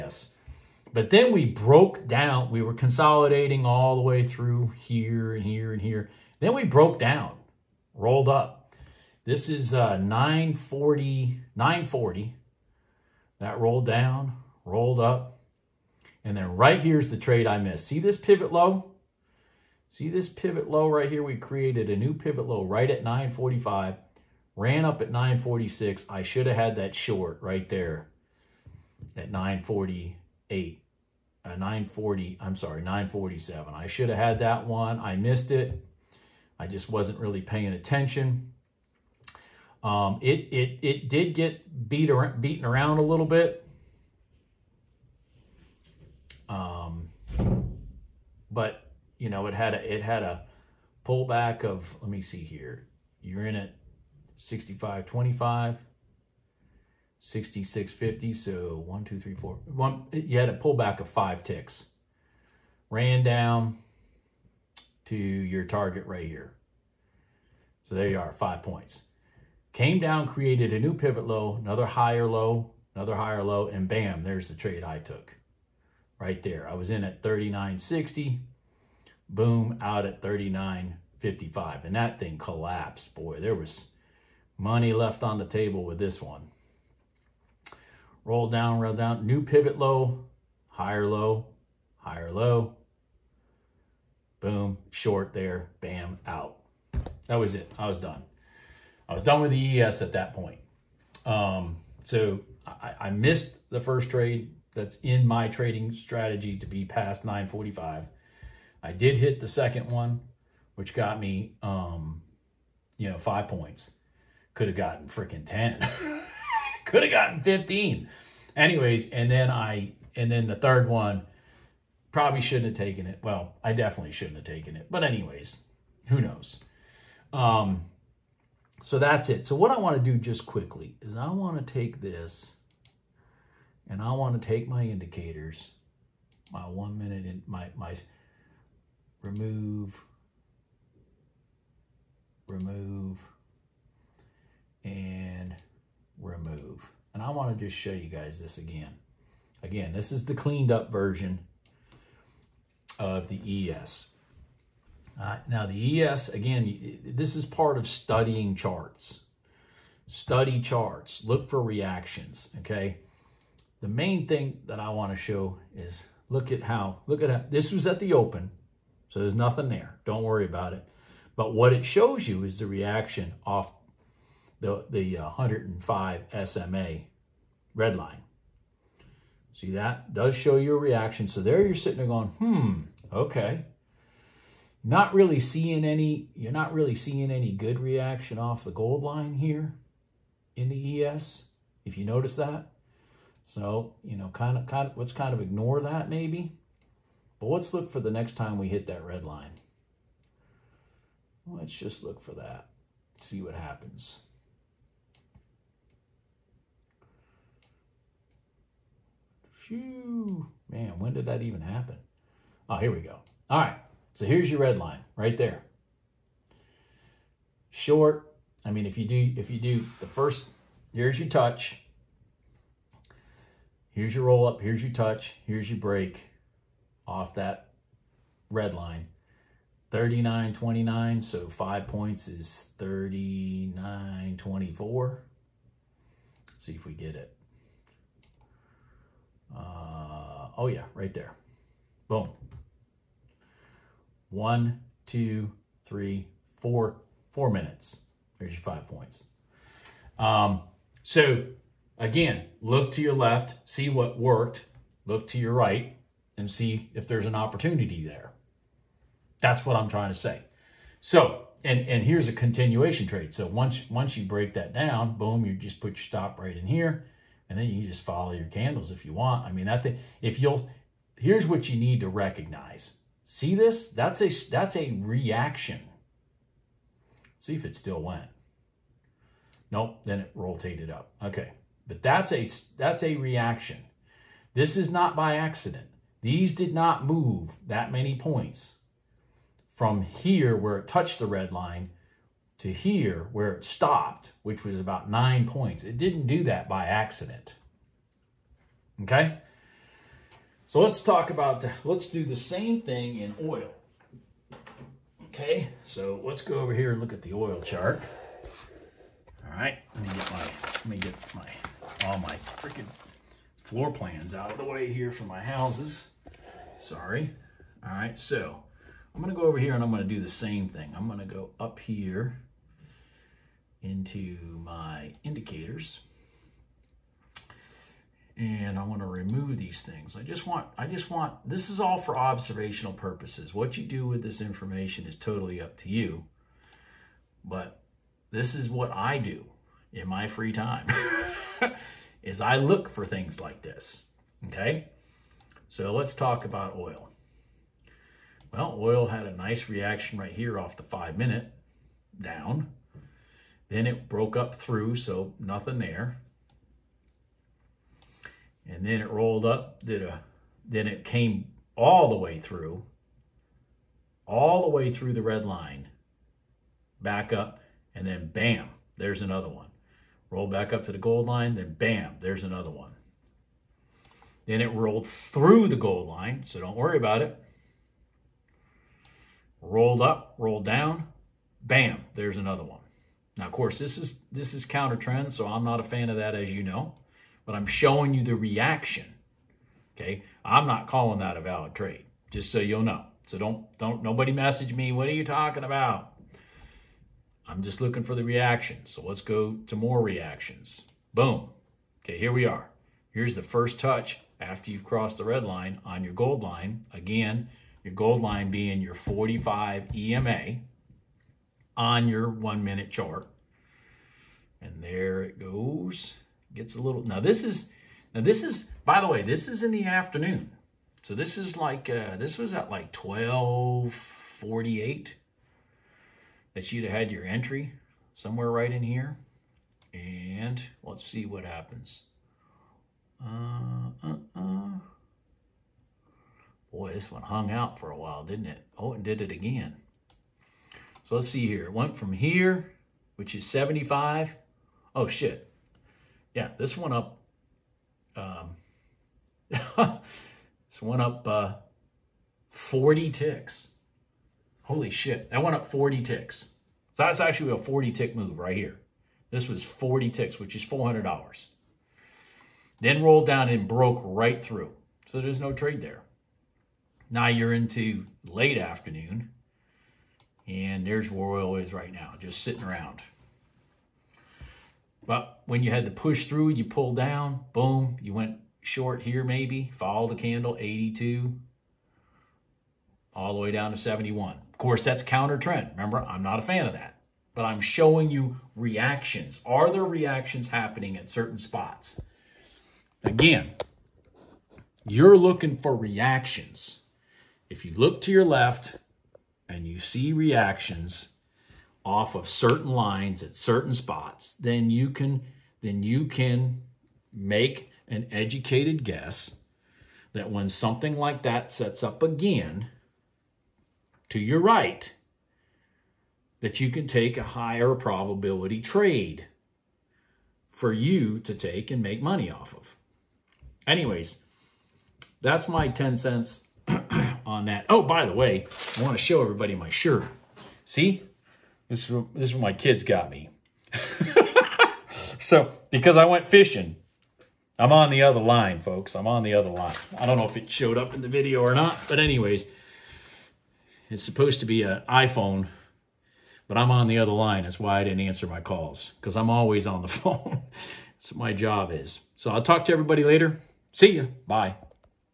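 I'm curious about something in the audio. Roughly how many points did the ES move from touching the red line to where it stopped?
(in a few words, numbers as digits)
9 points.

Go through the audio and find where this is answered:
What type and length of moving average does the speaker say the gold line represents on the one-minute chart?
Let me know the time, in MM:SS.
06:48.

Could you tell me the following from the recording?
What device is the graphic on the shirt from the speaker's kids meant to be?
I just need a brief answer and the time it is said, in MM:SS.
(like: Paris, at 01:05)
an iPhone, at 09:04.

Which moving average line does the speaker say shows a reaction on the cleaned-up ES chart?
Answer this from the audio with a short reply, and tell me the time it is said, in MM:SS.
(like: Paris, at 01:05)
105 SMA, at 02:55.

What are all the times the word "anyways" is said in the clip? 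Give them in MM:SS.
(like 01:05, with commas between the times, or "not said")
01:58, 02:05, 08:43, 09:01.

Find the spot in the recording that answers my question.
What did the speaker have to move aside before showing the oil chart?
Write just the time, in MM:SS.
05:13.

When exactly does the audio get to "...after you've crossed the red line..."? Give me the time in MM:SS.
06:44.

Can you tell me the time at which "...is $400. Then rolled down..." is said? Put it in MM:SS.
07:40.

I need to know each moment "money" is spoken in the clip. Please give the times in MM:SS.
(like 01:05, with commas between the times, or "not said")
01:24, 08:42.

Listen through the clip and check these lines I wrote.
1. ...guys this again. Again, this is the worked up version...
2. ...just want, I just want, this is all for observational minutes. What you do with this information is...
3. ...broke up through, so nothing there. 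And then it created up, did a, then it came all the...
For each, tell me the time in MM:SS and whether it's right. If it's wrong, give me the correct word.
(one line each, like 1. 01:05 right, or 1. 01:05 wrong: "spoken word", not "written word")
1. 02:28 wrong: "cleaned", not "worked"
2. 05:30 wrong: "purposes", not "minutes"
3. 05:54 wrong: "rolled", not "created".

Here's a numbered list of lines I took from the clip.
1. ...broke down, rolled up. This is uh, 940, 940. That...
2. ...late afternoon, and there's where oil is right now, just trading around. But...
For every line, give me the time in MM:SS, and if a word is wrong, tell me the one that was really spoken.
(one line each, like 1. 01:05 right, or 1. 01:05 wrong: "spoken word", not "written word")
1. 00:06 right
2. 07:48 wrong: "sitting", not "trading".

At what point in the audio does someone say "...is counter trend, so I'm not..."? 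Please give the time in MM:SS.
06:24.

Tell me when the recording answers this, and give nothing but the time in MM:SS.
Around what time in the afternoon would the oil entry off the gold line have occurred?
07:02.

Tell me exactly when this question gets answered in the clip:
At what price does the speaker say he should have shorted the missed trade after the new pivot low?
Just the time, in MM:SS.
00:29.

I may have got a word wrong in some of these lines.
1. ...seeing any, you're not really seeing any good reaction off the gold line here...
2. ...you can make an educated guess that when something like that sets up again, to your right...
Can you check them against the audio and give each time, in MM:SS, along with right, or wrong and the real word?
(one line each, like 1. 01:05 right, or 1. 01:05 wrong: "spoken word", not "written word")
1. 03:05 right
2. 08:25 right.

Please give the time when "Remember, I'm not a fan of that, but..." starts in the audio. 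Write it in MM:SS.
08:05.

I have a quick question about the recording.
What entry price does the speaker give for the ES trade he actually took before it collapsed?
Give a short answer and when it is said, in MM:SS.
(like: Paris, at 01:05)
39.60, at 01:17.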